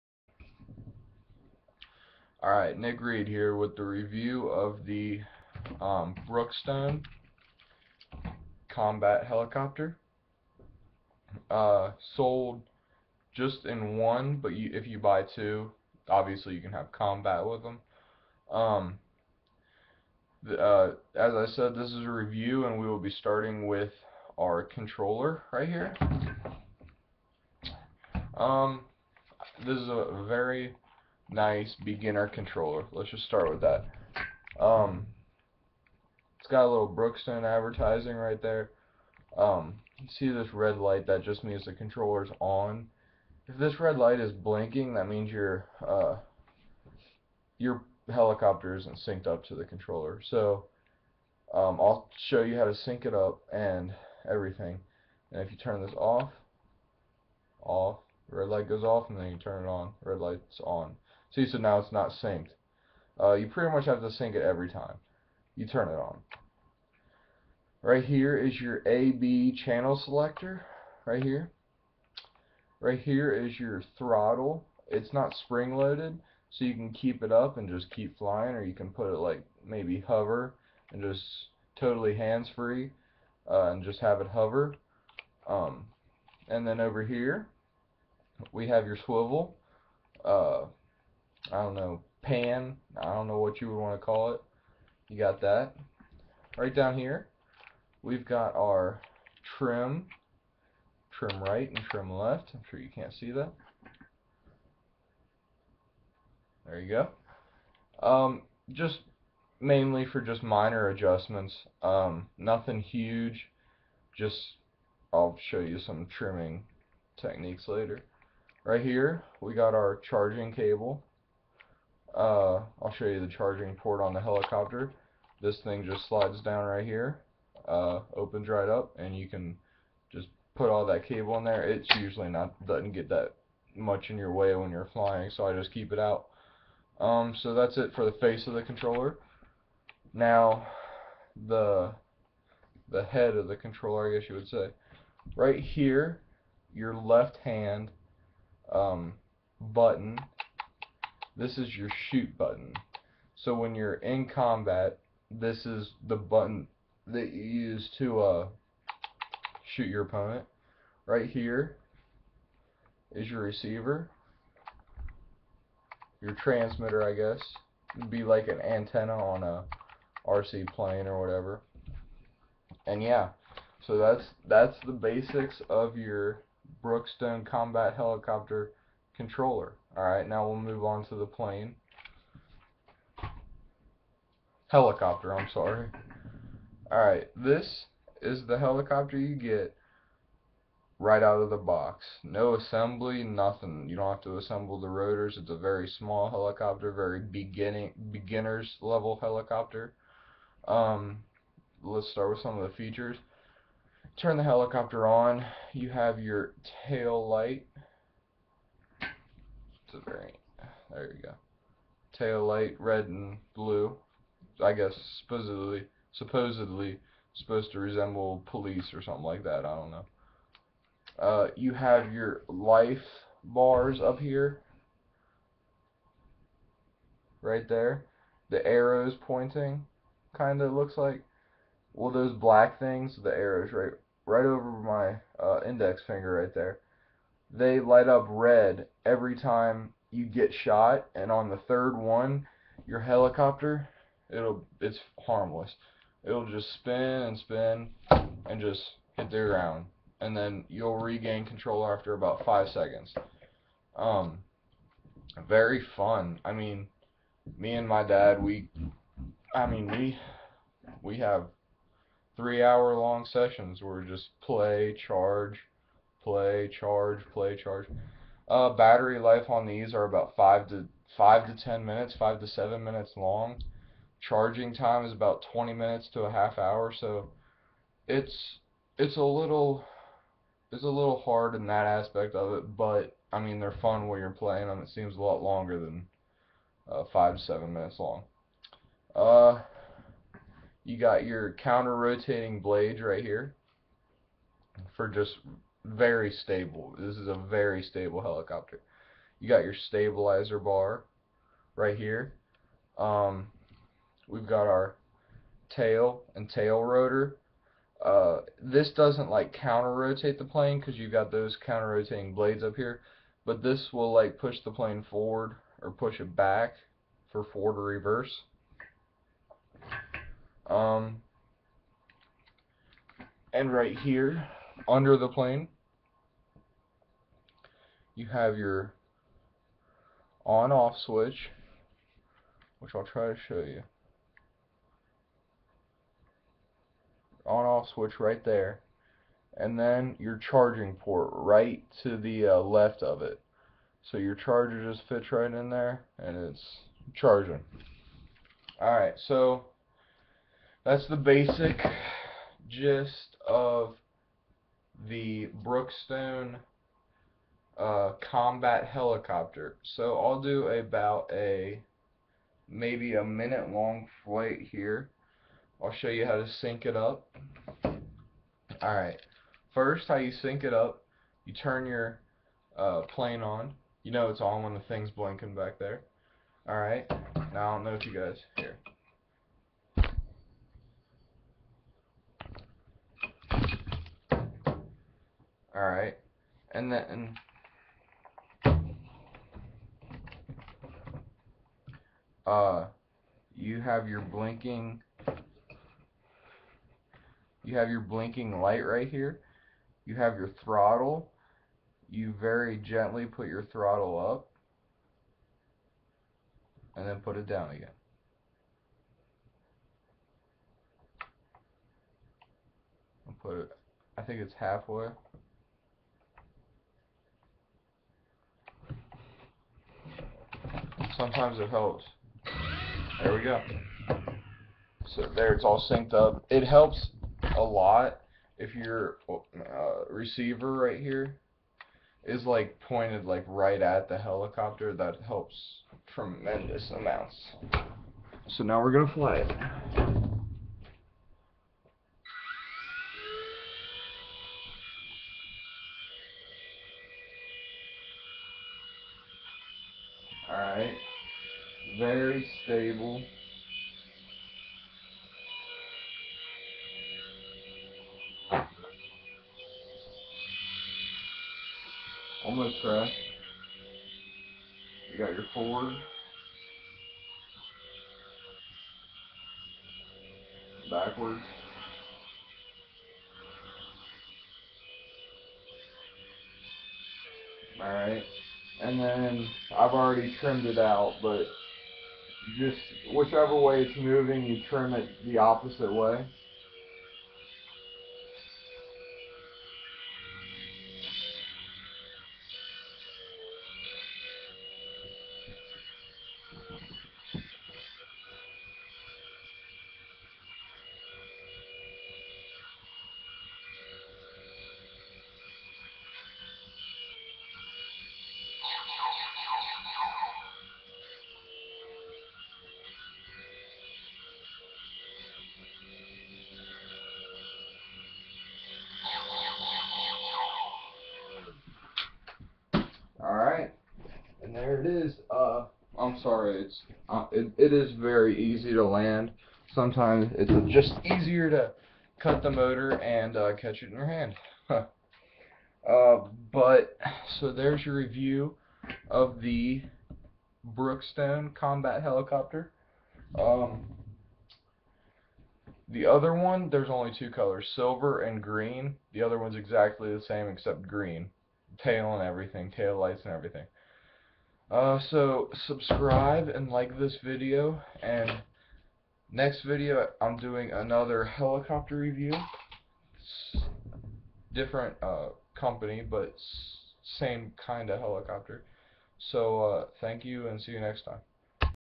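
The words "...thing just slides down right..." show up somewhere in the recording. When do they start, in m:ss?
2:05.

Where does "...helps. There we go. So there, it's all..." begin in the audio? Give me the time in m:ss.
7:01.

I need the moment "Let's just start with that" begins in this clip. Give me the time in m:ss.
0:32.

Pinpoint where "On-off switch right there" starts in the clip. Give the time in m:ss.
5:37.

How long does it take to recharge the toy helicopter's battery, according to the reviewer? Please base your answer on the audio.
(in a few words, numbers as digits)
20 minutes to half hour.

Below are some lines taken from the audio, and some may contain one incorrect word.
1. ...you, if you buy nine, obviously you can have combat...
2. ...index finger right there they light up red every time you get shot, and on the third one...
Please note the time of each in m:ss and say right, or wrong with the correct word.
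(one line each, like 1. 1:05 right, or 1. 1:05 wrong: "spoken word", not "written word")
1. 0:14 wrong: "two", not "nine"
2. 3:55 right.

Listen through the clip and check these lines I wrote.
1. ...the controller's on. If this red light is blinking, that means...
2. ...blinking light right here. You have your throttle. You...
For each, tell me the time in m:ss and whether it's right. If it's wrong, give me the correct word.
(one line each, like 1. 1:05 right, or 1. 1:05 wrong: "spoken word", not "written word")
1. 0:41 right
2. 6:38 right.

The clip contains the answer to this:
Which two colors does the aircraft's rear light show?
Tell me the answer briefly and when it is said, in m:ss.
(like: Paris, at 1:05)
Red and blue, at 3:32.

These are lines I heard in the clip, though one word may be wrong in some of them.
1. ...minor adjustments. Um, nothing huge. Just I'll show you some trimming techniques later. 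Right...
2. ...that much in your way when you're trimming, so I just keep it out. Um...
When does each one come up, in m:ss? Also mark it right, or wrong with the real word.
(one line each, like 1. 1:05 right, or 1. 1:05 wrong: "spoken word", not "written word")
1. 1:50 right
2. 2:13 wrong: "flying", not "trimming".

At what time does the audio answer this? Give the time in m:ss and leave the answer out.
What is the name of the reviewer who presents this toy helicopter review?
0:02.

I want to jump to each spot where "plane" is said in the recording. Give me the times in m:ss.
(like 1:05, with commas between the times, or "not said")
2:50, 3:01, 5:10, 5:14, 5:25, 6:13.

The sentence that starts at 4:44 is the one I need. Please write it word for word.
It seems a lot longer than uh, five to seven minutes long.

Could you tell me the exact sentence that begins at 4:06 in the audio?
It'll just spin and spin and just hit the ground, and then you'll regain control after about five seconds.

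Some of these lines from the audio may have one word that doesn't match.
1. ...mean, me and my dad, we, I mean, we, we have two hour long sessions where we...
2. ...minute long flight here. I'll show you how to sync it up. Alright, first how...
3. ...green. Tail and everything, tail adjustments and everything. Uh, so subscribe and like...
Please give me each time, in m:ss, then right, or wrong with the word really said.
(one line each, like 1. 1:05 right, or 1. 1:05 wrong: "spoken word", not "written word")
1. 4:16 wrong: "three", not "two"
2. 6:03 right
3. 9:10 wrong: "lights", not "adjustments".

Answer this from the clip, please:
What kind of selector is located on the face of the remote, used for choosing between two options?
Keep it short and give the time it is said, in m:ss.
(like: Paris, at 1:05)
AB channel selector, at 1:08.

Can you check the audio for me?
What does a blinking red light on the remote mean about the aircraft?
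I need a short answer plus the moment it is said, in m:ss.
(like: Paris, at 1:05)
Not synced, at 0:48.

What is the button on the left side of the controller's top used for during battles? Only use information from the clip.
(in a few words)
Shoot button.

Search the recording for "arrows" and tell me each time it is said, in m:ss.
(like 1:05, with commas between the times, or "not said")
3:48, 3:53.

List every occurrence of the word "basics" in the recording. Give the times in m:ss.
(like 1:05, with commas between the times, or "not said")
2:54, 5:51.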